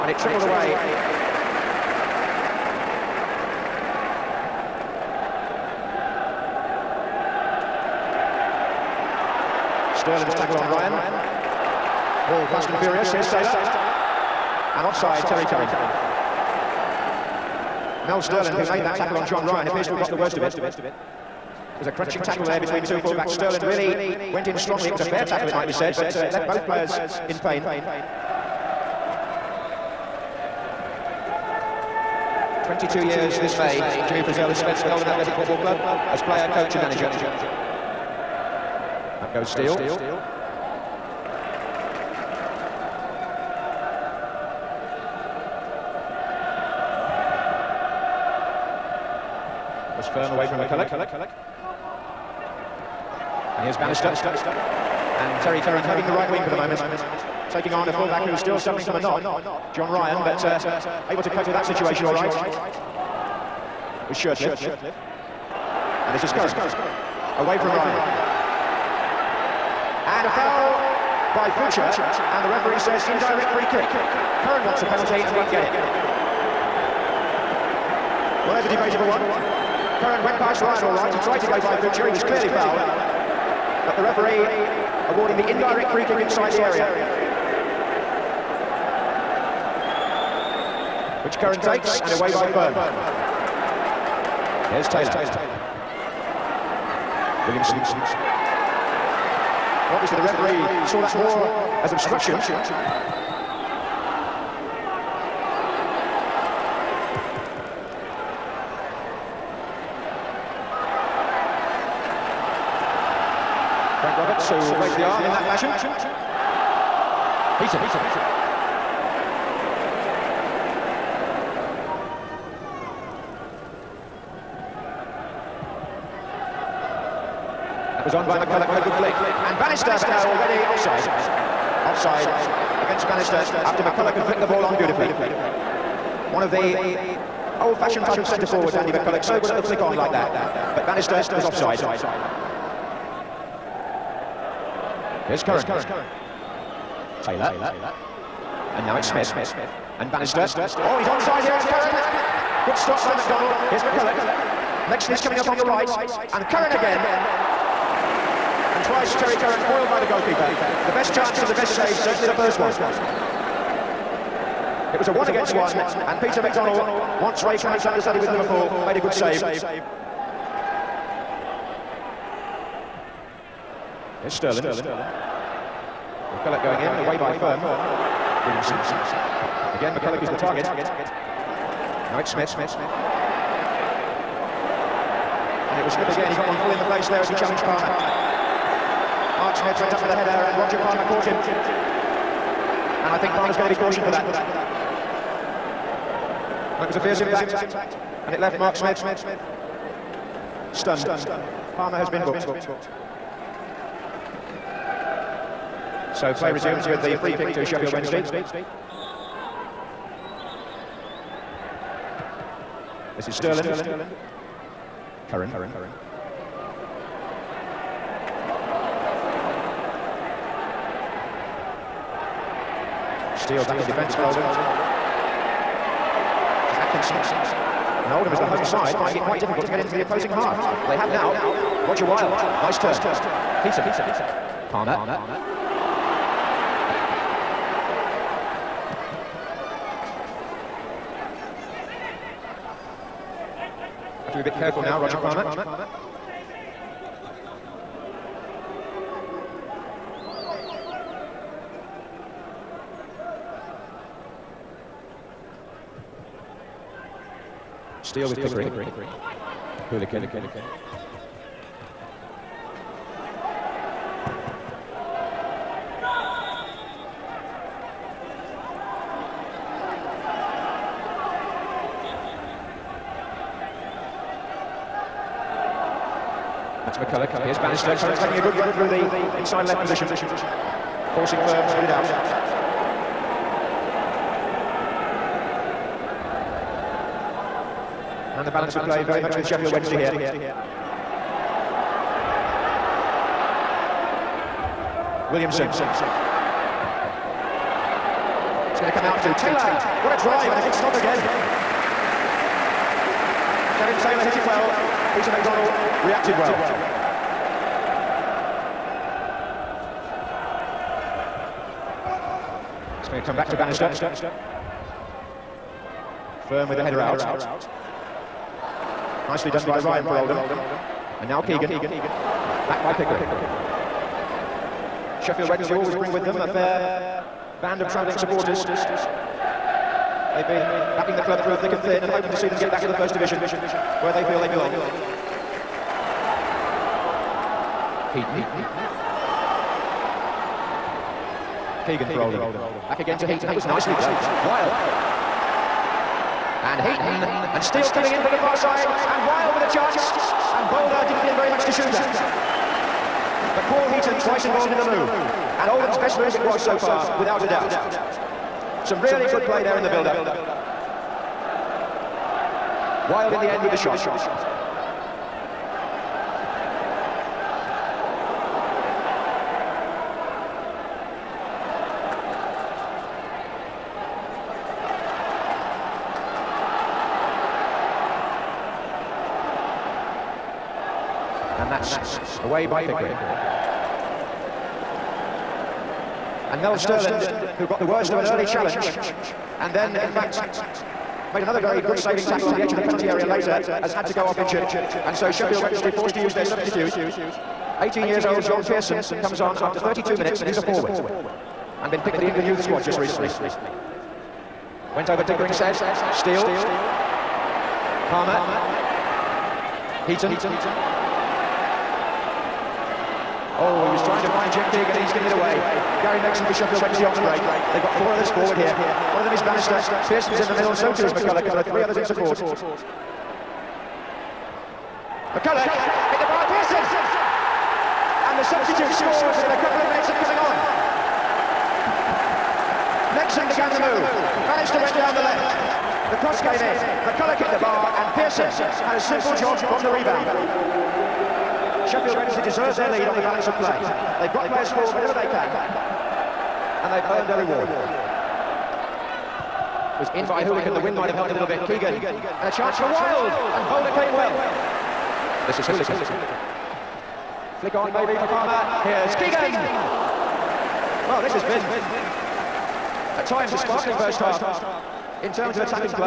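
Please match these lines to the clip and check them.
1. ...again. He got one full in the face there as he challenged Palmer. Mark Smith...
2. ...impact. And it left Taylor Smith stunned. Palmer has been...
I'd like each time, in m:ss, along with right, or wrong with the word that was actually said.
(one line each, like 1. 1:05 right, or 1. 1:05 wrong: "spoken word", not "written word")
1. 3:06 right
2. 3:17 wrong: "Mark", not "Taylor".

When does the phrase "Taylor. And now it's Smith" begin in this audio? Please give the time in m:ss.
2:27.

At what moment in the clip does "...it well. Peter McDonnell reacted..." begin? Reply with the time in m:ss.
5:04.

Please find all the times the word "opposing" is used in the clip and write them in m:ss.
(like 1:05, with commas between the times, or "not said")
3:50.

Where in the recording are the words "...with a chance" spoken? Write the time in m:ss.
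5:49.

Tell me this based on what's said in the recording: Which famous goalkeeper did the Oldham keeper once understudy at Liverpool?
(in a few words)
Ray Clemence.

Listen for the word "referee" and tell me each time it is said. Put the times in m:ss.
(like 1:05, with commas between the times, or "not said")
1:12, 1:24, 1:40.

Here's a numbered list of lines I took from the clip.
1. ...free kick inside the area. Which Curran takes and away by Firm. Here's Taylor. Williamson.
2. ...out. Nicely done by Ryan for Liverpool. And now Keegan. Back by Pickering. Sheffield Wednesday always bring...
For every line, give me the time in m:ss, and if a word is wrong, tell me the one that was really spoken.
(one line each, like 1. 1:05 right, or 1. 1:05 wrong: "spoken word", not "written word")
1. 1:25 right
2. 5:17 wrong: "Oldham", not "Liverpool".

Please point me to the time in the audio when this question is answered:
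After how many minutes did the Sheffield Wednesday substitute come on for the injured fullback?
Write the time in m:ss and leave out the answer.
6:39.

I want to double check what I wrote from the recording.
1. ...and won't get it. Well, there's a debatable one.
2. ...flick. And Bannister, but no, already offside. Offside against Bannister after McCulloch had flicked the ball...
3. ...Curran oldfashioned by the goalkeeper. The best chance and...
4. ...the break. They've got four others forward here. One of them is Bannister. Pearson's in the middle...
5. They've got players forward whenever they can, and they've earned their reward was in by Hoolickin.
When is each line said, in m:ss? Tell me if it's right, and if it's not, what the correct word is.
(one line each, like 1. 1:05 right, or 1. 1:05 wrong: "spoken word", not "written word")
1. 1:15 right
2. 2:08 right
3. 2:39 wrong: "foiled", not "oldfashioned"
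4. 6:57 right
5. 7:24 right.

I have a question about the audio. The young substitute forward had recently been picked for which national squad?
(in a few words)
England youth squad.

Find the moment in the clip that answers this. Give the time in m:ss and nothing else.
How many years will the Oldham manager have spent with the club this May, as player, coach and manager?
0:32.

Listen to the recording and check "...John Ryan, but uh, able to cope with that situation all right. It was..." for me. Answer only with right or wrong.
right.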